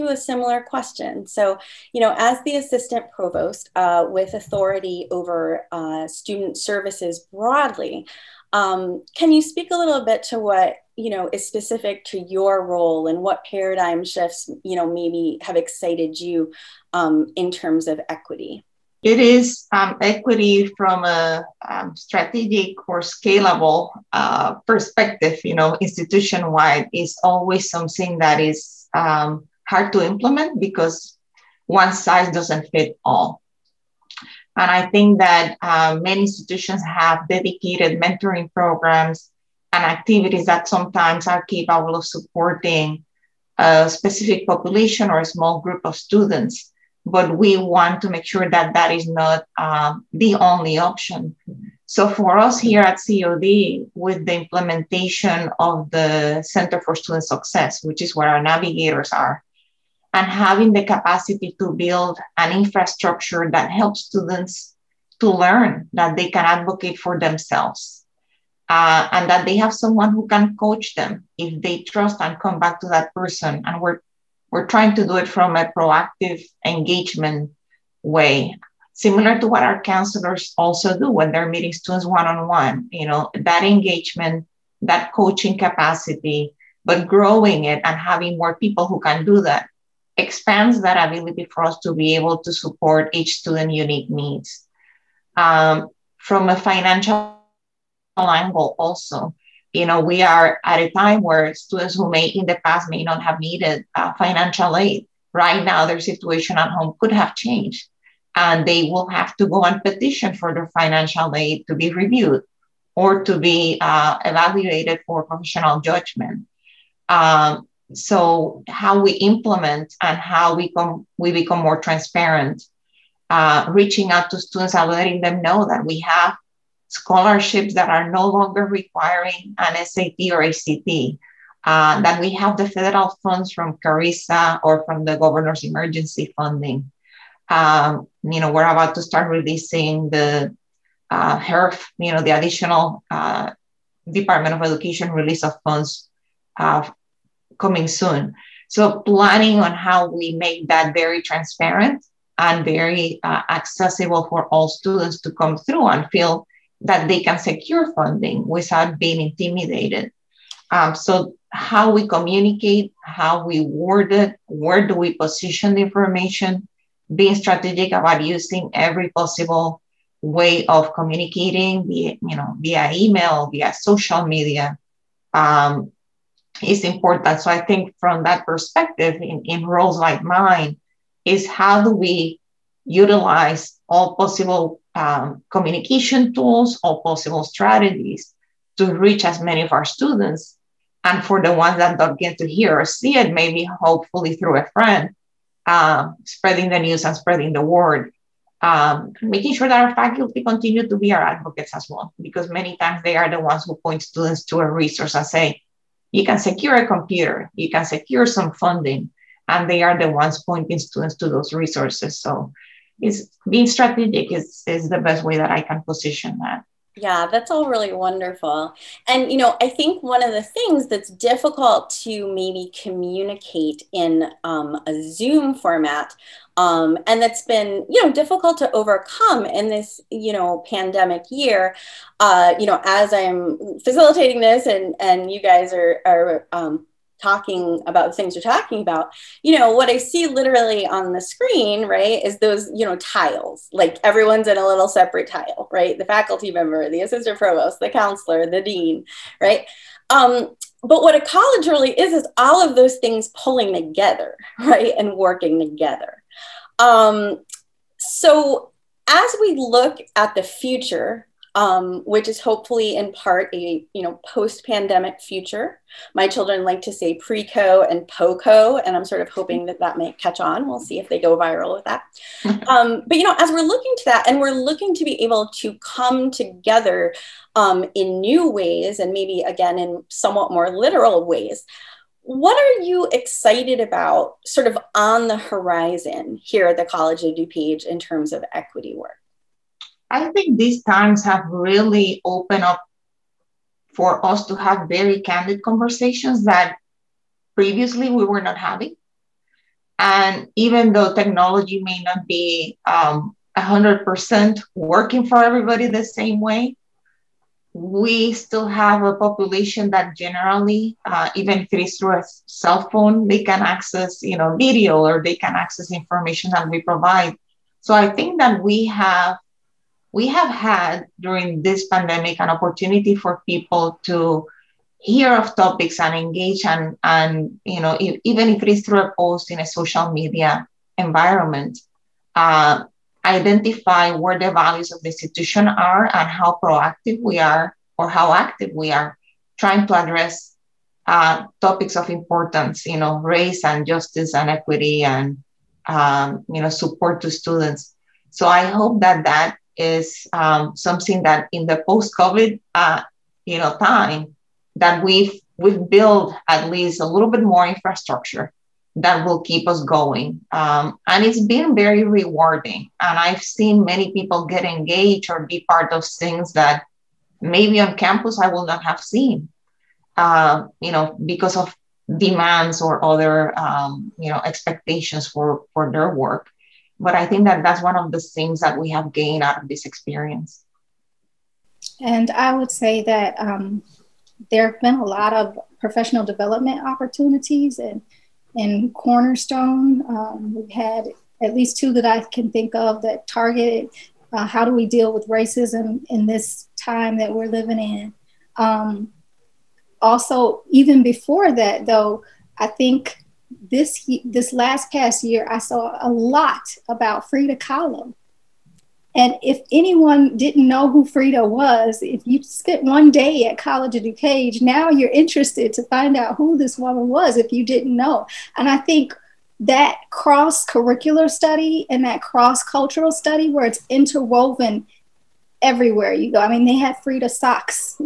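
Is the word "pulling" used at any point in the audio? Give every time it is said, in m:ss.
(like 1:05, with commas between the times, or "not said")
4:13.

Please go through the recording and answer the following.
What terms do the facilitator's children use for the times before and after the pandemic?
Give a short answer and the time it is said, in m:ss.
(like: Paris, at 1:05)
pre-co and po-co, at 4:27.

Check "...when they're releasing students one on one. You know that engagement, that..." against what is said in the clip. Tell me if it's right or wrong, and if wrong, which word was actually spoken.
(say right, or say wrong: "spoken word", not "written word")
wrong: "meeting", not "releasing".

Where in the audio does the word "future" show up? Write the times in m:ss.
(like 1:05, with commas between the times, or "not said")
4:20, 4:25.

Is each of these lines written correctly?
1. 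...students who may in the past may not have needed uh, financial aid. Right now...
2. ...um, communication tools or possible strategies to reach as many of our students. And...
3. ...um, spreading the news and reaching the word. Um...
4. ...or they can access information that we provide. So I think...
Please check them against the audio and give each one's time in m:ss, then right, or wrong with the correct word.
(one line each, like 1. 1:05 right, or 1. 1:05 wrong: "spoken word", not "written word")
1. 1:41 right
2. 3:04 right
3. 3:15 wrong: "spreading", not "reaching"
4. 5:15 right.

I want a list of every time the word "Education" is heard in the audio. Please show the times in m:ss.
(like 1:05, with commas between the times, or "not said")
2:24.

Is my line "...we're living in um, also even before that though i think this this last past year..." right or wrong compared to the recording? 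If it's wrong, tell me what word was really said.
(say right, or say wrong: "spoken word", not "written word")
right.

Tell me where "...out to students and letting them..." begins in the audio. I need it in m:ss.
2:04.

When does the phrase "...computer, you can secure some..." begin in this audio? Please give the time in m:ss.
3:26.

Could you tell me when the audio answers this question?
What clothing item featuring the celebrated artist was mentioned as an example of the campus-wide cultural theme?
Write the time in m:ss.
7:07.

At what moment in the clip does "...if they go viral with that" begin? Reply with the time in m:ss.
4:30.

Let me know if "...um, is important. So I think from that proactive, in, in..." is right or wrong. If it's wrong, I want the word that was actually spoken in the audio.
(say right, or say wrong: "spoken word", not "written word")
wrong: "perspective", not "proactive".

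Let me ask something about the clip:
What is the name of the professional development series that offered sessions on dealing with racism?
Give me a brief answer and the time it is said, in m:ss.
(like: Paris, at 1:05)
Cornerstone, at 6:28.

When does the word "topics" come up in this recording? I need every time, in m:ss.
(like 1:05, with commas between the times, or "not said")
5:25, 5:41.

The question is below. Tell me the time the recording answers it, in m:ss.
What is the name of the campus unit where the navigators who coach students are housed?
0:56.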